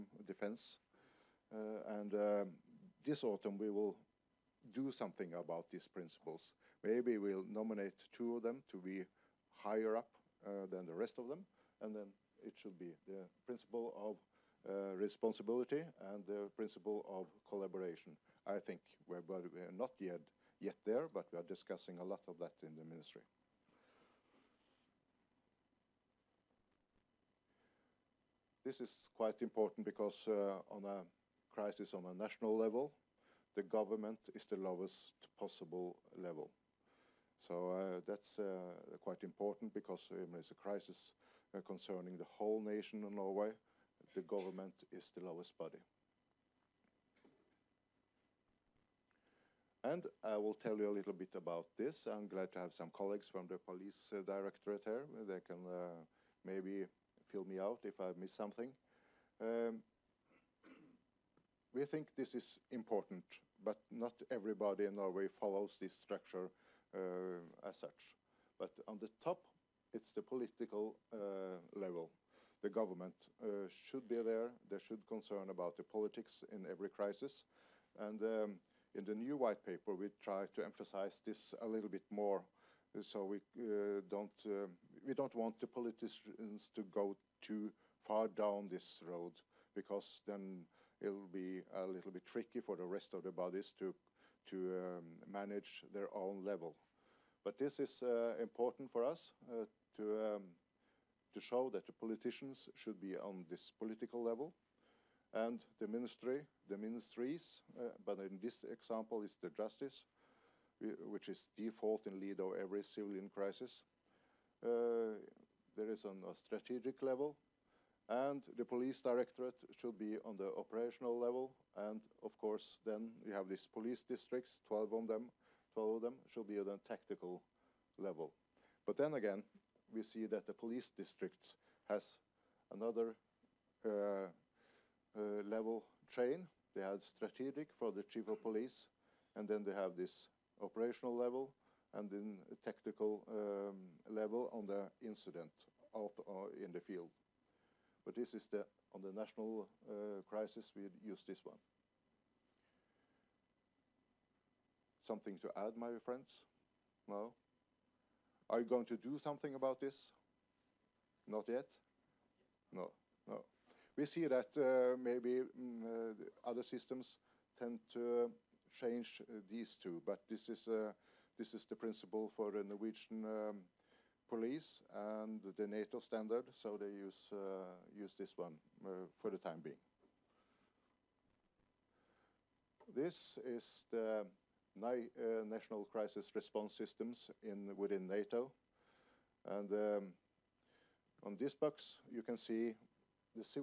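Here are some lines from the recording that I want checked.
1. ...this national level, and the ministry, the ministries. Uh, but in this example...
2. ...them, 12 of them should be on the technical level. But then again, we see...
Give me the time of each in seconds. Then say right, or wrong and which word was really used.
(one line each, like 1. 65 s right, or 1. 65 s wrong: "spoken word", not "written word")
1. 103 s wrong: "political", not "national"
2. 125 s wrong: "tactical", not "technical".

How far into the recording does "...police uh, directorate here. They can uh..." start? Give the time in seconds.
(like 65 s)
53 s.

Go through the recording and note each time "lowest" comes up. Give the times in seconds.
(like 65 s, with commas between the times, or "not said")
34 s, 45 s.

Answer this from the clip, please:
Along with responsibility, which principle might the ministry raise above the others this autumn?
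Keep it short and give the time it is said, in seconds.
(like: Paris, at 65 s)
Collaboration, at 16 s.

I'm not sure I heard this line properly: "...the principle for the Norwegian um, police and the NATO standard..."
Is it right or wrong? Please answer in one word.
right.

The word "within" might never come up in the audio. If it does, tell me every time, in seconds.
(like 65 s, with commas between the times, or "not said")
187 s.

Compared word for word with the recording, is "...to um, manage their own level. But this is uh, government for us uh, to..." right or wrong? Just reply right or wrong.
wrong.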